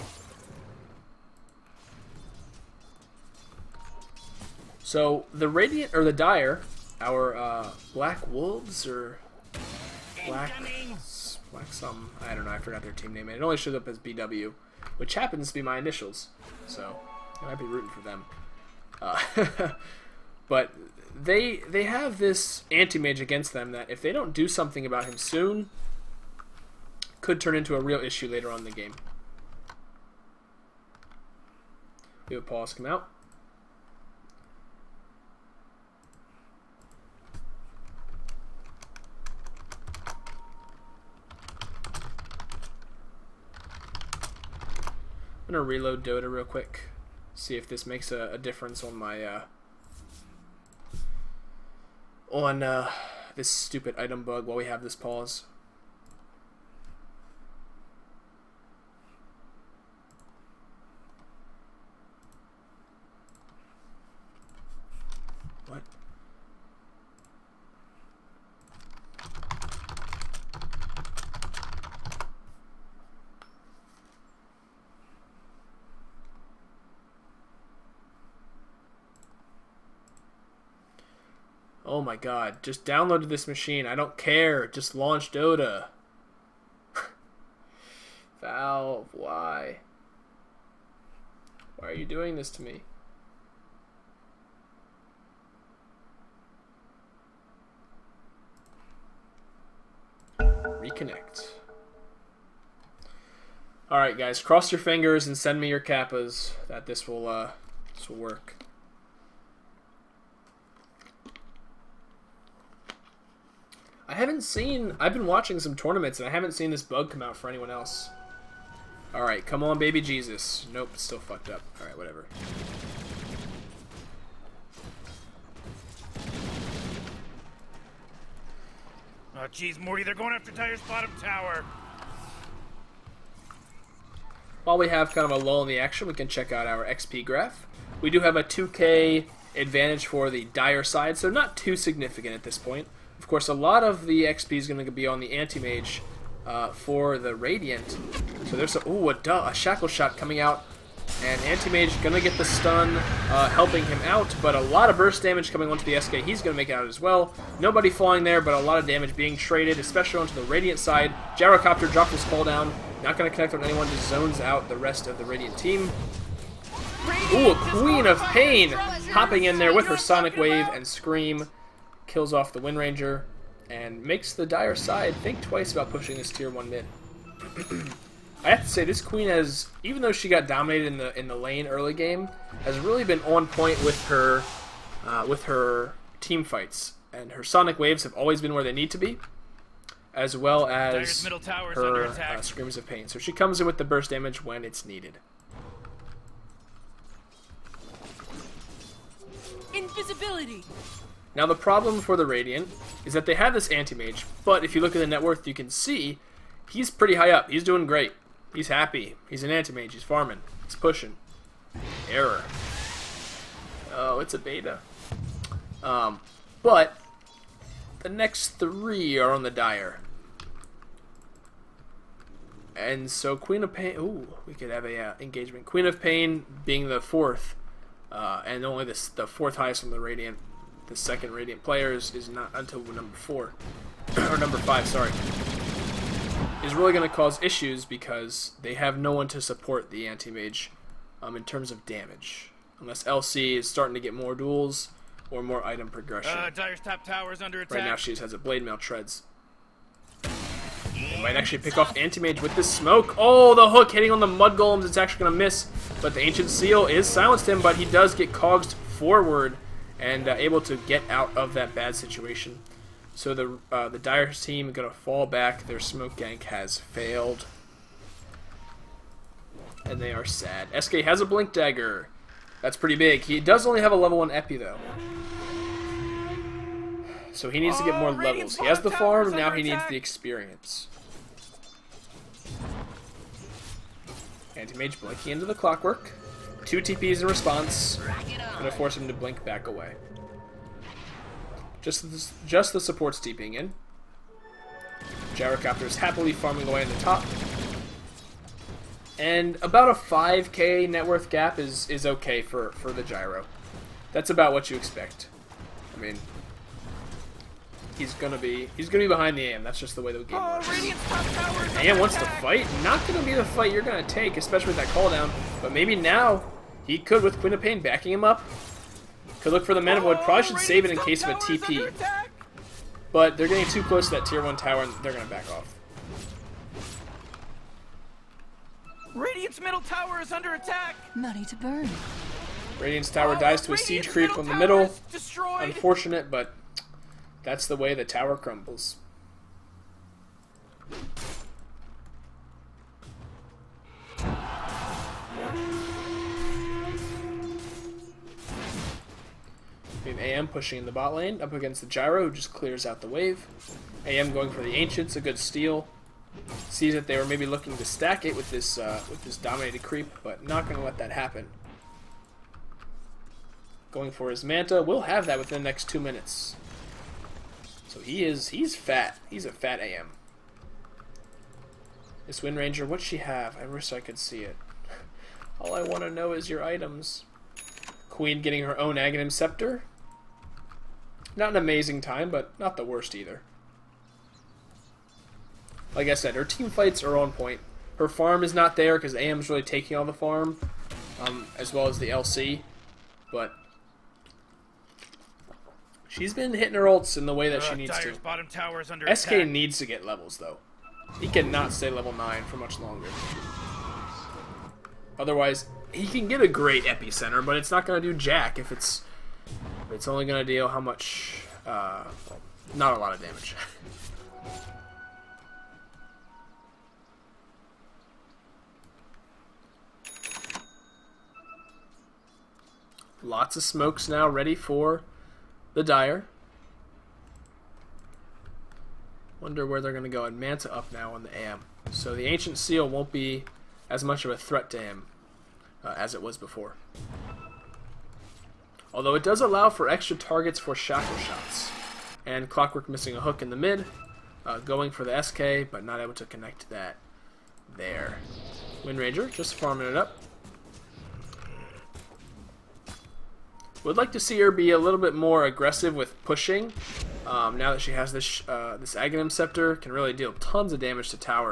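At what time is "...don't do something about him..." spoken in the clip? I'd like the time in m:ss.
0:24.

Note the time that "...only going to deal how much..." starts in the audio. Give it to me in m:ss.
6:50.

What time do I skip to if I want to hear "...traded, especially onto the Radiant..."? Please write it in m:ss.
2:39.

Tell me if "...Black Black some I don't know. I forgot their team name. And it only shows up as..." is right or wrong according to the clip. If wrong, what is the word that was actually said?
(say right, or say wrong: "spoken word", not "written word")
right.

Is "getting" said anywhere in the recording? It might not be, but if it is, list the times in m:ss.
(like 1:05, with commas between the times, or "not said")
5:23, 6:18.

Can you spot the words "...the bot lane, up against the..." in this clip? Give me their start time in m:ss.
5:50.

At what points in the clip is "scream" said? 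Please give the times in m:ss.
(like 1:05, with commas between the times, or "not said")
2:50, 3:12.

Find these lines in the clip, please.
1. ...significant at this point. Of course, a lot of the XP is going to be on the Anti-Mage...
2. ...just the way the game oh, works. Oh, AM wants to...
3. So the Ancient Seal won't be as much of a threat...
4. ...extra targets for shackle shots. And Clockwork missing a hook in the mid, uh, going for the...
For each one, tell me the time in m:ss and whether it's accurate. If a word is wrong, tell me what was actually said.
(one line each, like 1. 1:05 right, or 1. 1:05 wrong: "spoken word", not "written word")
1. 2:21 right
2. 5:09 right
3. 7:11 right
4. 7:19 right.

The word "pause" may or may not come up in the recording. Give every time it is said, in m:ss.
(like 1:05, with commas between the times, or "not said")
0:32, 0:54.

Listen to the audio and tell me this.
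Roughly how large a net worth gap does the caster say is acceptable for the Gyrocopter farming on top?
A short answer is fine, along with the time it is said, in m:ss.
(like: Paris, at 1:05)
5k, at 4:59.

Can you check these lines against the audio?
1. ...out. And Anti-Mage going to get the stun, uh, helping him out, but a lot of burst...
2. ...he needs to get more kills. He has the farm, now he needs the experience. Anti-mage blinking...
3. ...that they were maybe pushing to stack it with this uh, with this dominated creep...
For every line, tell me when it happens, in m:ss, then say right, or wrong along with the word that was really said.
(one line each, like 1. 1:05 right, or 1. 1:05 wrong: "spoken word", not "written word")
1. 2:30 right
2. 4:37 wrong: "levels", not "kills"
3. 5:56 wrong: "looking", not "pushing".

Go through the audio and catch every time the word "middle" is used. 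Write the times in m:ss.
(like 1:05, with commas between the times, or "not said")
5:29, 5:34.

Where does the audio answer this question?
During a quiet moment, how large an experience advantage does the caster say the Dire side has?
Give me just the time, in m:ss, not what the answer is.
2:18.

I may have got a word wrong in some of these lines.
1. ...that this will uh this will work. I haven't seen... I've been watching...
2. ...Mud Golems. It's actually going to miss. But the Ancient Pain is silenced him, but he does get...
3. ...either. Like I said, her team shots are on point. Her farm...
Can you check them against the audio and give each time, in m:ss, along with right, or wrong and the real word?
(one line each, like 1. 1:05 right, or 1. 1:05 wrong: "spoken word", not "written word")
1. 1:46 right
2. 4:14 wrong: "Seal", not "Pain"
3. 6:23 wrong: "fights", not "shots".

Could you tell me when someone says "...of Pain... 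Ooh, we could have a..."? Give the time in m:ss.
3:43.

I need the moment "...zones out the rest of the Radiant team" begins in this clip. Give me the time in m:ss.
2:44.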